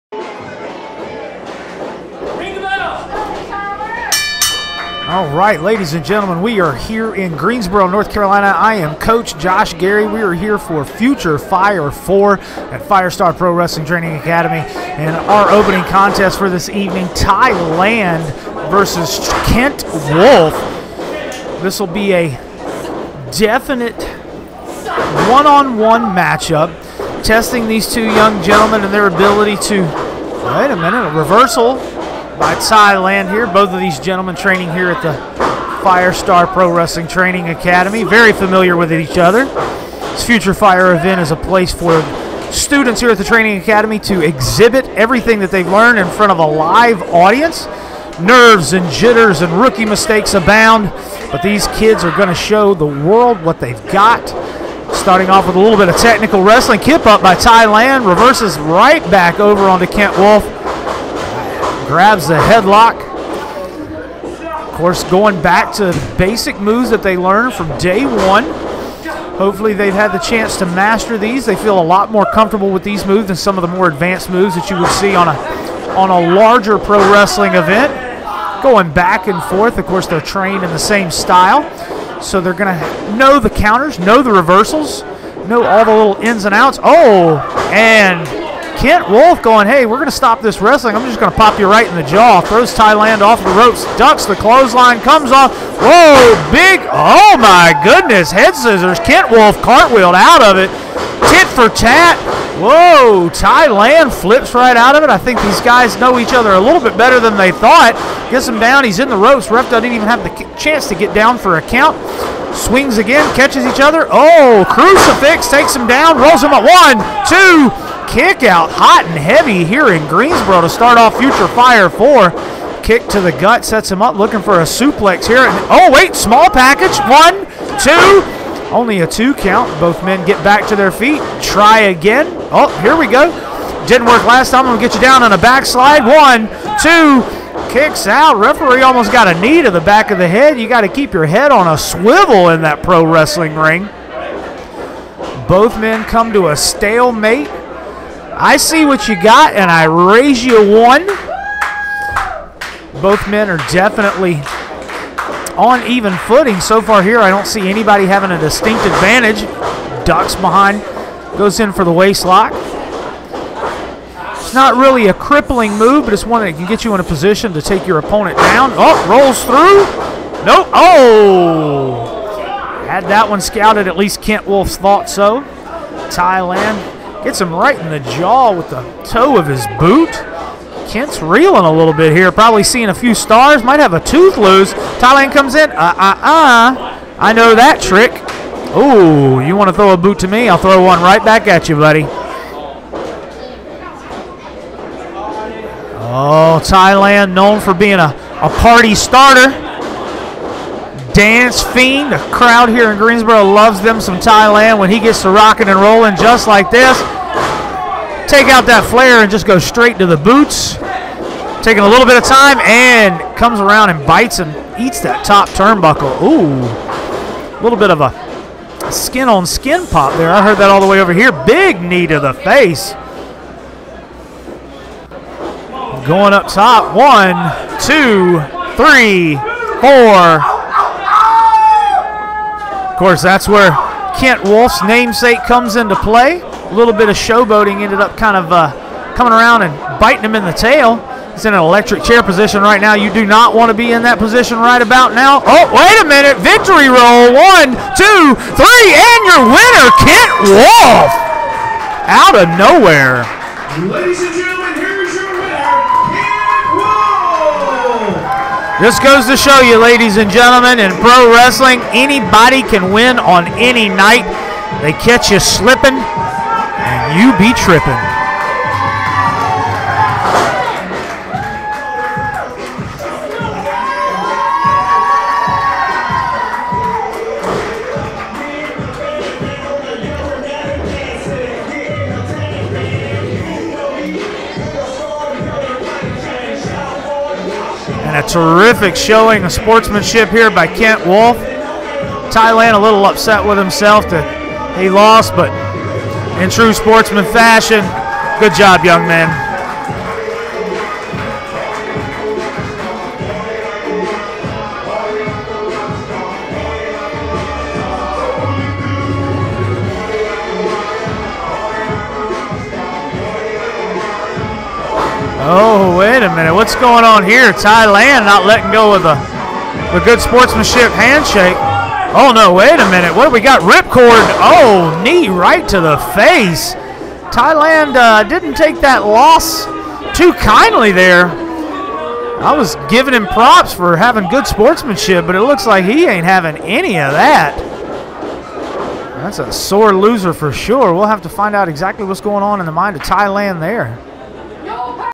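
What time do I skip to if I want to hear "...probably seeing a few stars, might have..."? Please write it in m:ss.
3:02.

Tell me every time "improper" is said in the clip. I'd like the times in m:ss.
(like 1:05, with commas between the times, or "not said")
not said.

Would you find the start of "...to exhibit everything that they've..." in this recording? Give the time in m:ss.
0:43.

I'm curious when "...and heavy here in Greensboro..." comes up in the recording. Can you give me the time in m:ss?
1:59.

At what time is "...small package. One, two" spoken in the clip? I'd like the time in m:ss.
2:06.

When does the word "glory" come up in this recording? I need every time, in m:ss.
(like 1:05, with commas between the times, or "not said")
not said.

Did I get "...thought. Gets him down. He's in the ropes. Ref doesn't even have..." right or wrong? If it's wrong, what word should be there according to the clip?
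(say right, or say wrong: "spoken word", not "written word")
right.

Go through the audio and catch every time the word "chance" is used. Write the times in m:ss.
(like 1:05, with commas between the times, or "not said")
1:10, 1:50.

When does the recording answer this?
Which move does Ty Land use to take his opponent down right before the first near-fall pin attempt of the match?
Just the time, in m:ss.
1:54.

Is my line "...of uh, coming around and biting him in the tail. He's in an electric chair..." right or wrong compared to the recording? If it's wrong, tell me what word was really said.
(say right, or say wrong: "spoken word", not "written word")
right.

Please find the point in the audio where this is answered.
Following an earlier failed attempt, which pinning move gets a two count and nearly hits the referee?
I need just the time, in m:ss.
2:15.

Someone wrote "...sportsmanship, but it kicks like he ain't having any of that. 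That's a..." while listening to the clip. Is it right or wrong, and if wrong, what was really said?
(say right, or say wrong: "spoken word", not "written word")
wrong: "looks", not "kicks".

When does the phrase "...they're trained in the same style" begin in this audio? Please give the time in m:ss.
1:20.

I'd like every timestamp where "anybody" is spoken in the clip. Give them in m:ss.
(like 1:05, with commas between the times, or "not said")
2:37, 4:21.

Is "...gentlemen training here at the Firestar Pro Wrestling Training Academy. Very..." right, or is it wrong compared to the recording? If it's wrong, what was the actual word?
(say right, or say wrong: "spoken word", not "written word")
right.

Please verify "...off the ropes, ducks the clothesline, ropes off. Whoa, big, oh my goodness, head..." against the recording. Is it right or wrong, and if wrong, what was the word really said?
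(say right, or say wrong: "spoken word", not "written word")
wrong: "comes", not "ropes".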